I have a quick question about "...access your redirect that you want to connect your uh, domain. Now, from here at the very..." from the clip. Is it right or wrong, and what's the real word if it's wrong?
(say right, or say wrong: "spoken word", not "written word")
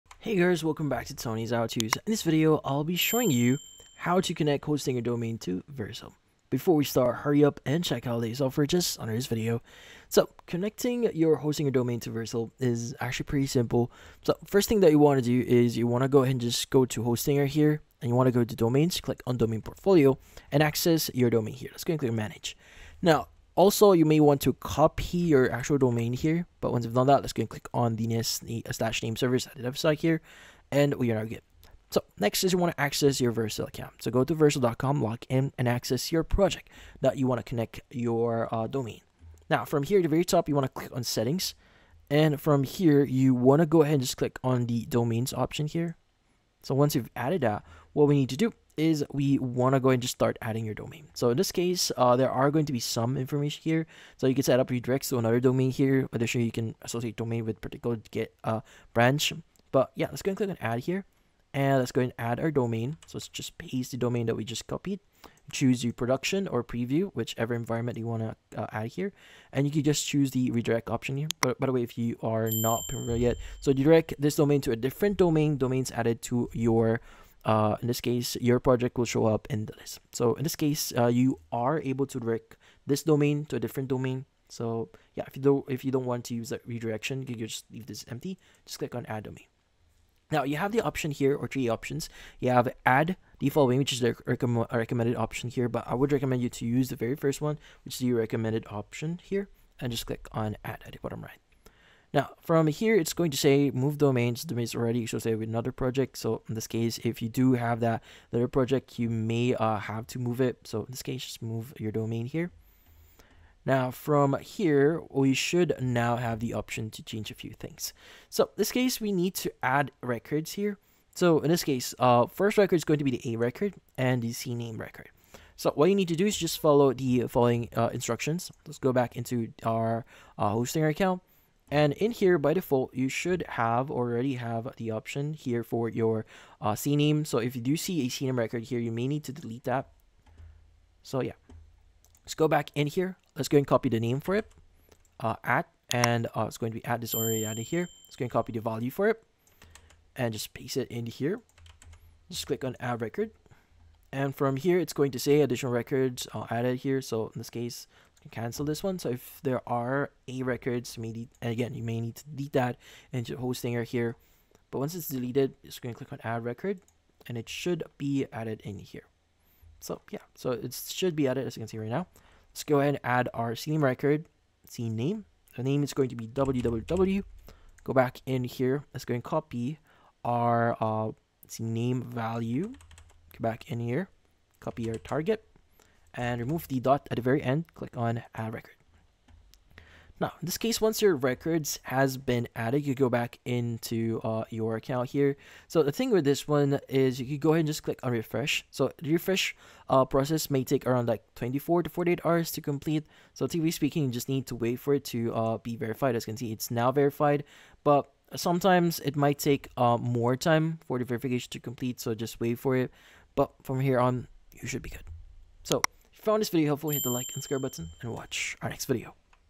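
wrong: "project", not "redirect".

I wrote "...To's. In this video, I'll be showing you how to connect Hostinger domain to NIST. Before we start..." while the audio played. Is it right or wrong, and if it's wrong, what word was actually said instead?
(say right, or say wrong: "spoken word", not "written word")
wrong: "Vercel", not "NIST".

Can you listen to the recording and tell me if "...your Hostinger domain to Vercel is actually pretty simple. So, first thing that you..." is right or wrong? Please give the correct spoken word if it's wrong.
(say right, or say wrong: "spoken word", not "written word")
right.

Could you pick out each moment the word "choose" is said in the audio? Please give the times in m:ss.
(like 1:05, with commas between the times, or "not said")
1:05, 1:10.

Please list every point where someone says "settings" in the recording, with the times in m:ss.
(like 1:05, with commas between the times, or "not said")
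0:41.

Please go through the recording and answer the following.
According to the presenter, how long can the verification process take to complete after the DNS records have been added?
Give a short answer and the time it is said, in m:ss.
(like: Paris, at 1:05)
24 to 48 hours, at 3:21.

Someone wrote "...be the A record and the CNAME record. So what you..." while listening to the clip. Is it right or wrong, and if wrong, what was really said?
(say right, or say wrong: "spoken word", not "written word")
right.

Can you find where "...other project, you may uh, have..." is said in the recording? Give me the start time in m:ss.
1:48.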